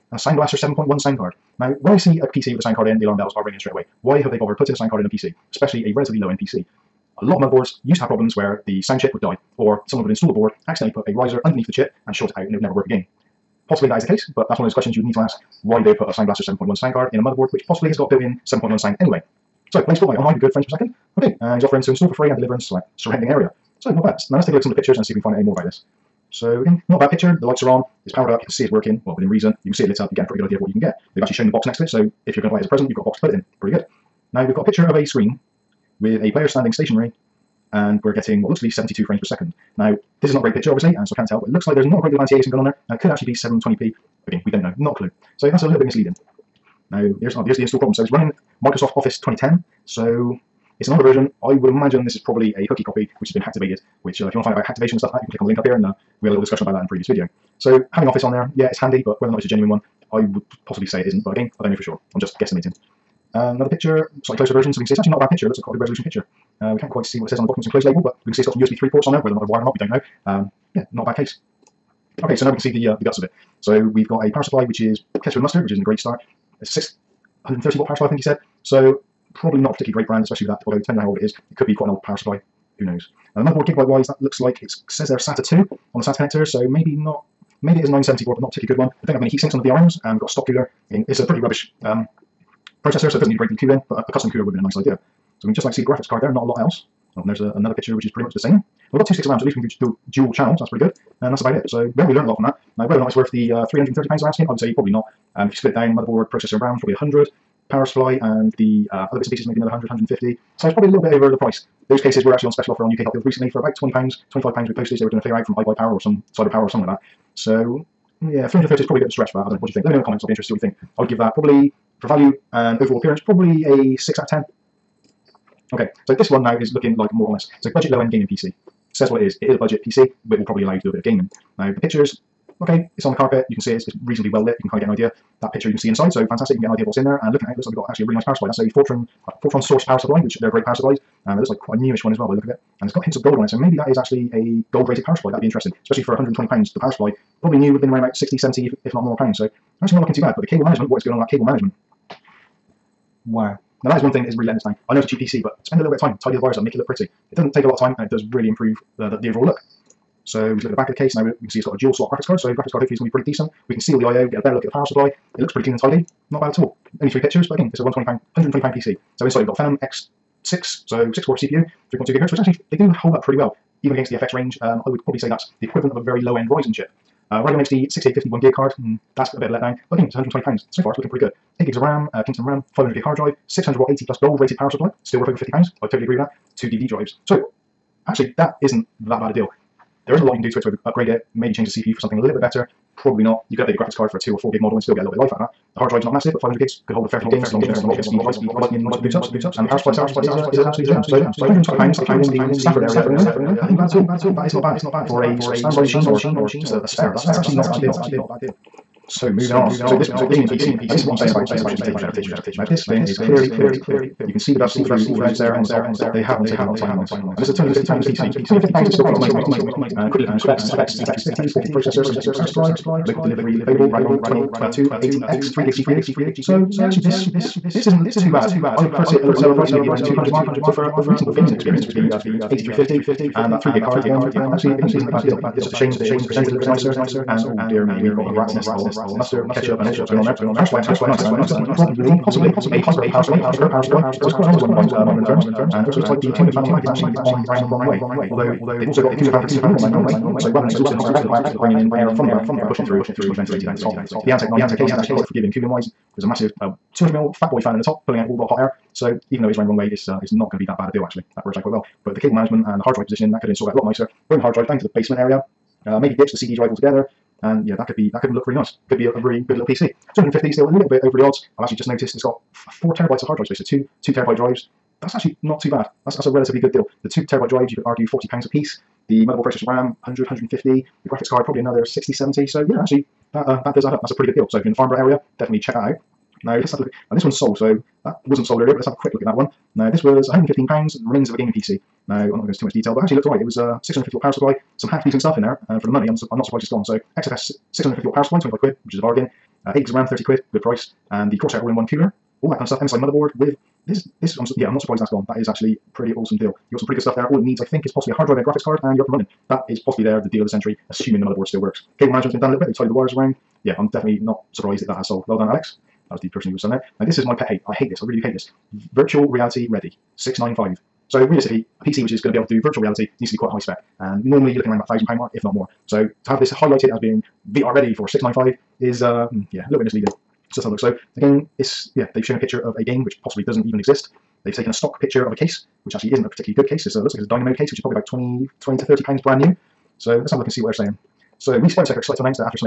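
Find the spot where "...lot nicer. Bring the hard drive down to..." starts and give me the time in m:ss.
4:23.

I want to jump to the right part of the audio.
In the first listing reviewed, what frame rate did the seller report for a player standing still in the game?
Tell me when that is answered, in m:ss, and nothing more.
0:38.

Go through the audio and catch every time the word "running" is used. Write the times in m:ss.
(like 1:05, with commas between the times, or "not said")
0:48, 4:19, 5:09.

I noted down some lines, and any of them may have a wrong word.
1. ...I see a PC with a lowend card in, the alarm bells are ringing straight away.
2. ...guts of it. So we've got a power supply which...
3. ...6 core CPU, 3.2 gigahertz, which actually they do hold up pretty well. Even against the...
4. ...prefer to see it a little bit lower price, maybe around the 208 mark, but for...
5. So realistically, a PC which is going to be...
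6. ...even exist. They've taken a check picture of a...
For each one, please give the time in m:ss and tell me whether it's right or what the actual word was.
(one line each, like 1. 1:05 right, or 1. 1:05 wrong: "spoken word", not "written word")
1. 0:01 wrong: "sound", not "lowend"
2. 1:13 right
3. 2:51 right
4. 3:48 wrong: "200", not "208"
5. 5:21 right
6. 5:33 wrong: "stock", not "check".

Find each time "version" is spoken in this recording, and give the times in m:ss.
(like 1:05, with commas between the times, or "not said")
0:51, 1:04.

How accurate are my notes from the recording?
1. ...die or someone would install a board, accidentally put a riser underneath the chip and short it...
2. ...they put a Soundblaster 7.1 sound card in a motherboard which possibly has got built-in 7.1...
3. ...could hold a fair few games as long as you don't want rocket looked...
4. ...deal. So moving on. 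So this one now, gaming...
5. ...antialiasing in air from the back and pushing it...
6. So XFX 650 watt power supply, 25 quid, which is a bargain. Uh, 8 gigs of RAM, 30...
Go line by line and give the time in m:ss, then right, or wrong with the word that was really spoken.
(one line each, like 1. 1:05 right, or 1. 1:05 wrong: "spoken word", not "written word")
1. 0:09 right
2. 0:15 right
3. 3:16 wrong: "speed", not "looked"
4. 3:27 right
5. 4:11 wrong: "bringing", not "antialiasing"
6. 4:56 right.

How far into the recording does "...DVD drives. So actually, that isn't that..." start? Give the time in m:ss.
3:06.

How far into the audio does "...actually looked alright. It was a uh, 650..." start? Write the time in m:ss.
4:53.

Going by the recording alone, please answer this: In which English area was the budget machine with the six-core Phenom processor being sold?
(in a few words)
Stafford.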